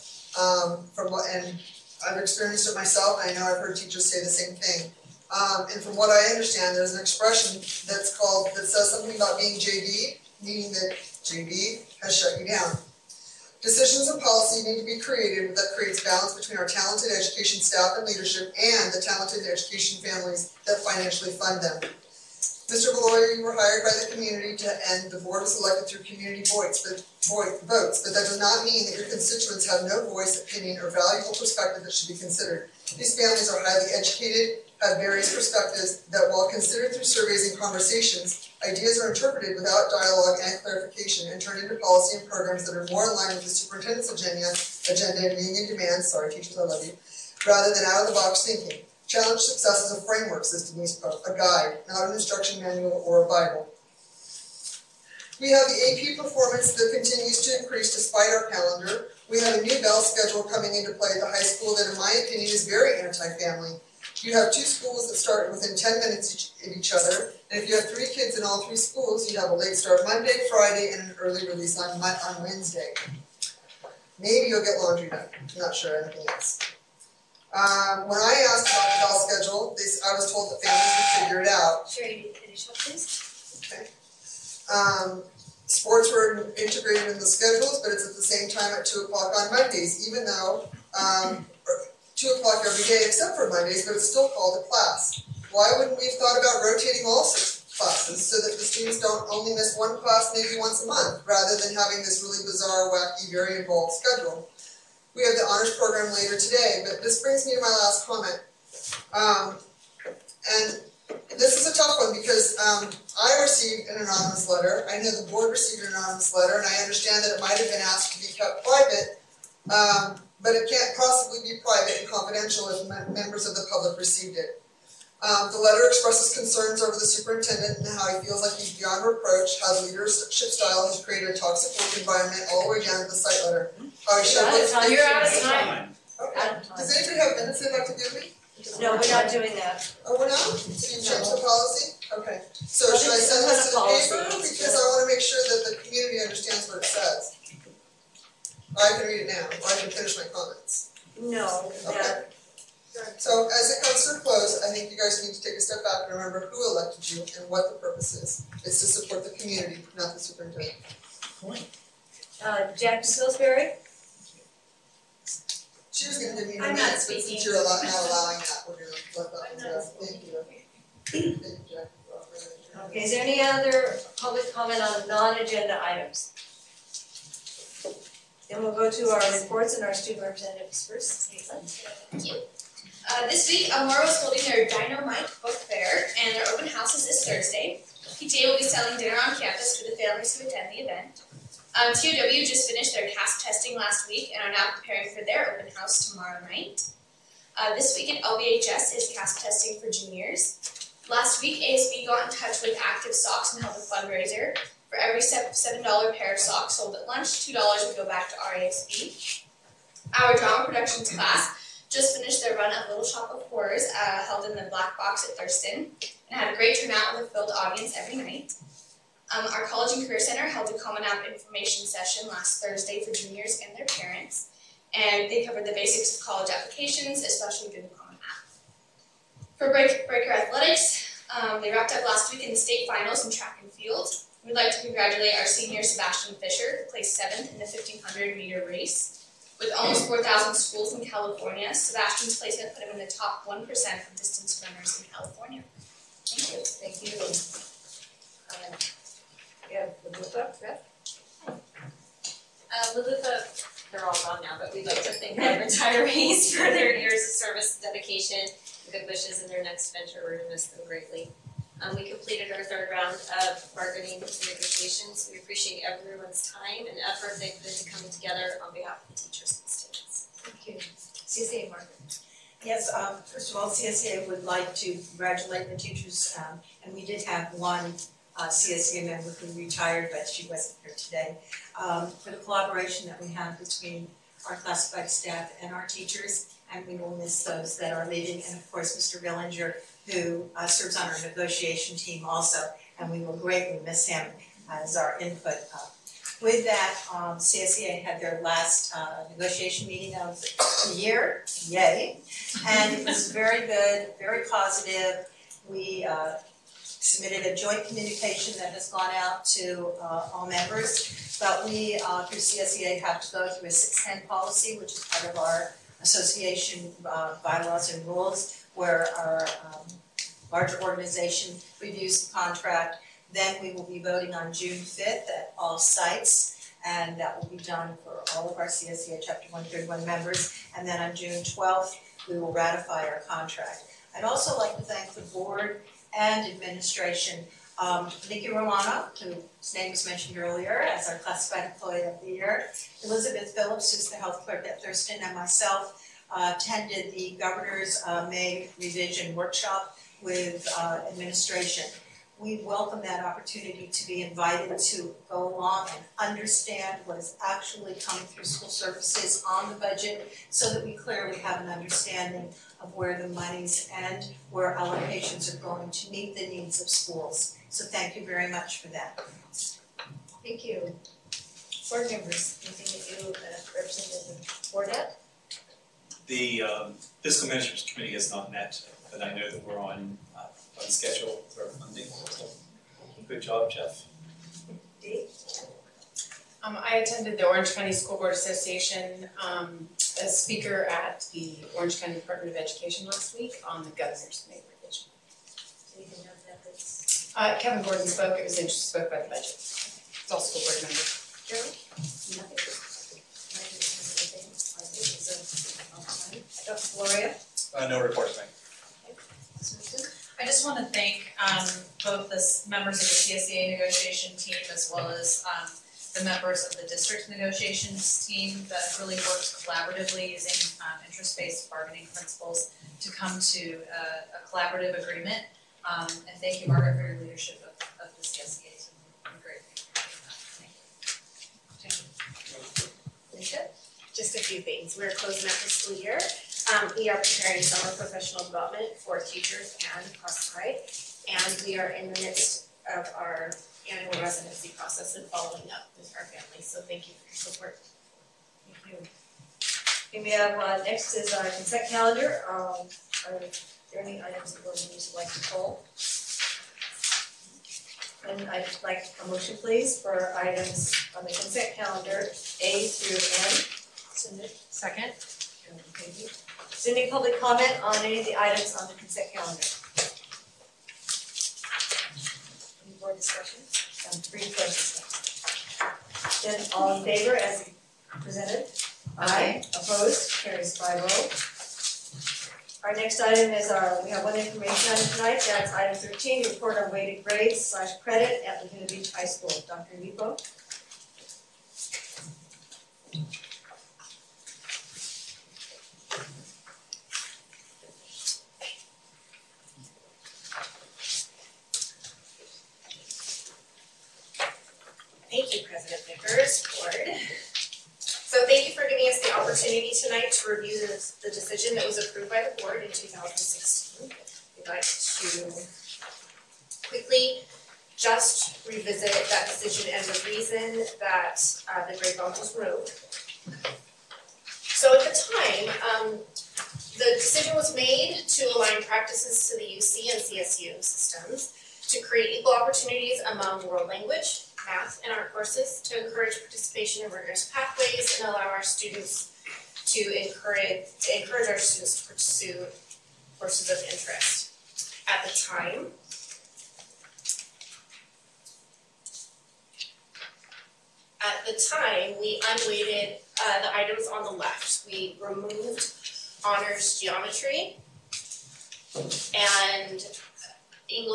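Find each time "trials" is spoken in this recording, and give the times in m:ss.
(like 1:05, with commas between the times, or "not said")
not said.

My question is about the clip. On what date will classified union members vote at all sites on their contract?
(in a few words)
June 5.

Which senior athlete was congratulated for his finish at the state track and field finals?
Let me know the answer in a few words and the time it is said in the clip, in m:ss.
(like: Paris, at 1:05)
Sebastian Fisher, at 3:55.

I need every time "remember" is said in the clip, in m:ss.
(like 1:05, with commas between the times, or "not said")
2:36.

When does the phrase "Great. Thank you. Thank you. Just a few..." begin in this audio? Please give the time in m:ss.
7:09.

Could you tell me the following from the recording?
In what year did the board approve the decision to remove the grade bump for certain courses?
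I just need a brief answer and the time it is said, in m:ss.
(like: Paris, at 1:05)
2016, at 8:32.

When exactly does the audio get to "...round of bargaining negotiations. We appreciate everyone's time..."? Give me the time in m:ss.
4:22.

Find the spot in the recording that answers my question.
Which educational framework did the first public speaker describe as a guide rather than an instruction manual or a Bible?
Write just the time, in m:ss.
0:49.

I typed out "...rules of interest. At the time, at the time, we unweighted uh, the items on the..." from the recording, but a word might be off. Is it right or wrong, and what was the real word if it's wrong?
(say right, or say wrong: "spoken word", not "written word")
wrong: "courses", not "rules".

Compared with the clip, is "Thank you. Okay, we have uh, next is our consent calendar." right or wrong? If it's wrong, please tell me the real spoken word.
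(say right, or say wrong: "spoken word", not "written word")
right.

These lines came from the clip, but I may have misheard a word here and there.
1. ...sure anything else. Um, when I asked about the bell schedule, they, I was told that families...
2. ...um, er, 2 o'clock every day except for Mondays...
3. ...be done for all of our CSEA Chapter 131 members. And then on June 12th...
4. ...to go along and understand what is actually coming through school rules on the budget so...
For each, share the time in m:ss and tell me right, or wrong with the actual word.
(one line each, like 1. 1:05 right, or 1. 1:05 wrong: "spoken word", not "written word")
1. 1:15 right
2. 1:30 right
3. 5:27 right
4. 5:54 wrong: "services", not "rules".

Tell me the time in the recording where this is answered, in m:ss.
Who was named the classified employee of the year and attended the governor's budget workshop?
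5:38.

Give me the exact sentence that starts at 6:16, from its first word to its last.
The um, fiscal management committee has not met uh, and I know that we're on, uh, on schedule for our funding.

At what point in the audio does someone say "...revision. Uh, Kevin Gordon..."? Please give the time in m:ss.
6:34.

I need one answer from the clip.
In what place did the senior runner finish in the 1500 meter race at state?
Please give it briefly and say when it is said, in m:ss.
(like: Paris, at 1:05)
Seventh, at 3:57.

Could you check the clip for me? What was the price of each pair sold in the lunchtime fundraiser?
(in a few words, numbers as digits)
$7.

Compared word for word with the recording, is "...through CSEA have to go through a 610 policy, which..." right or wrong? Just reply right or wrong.
right.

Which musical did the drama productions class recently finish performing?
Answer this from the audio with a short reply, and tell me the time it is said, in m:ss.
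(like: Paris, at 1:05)
Little Shop of Horrors, at 3:32.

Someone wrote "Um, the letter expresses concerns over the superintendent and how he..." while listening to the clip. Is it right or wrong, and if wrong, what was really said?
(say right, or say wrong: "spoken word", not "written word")
right.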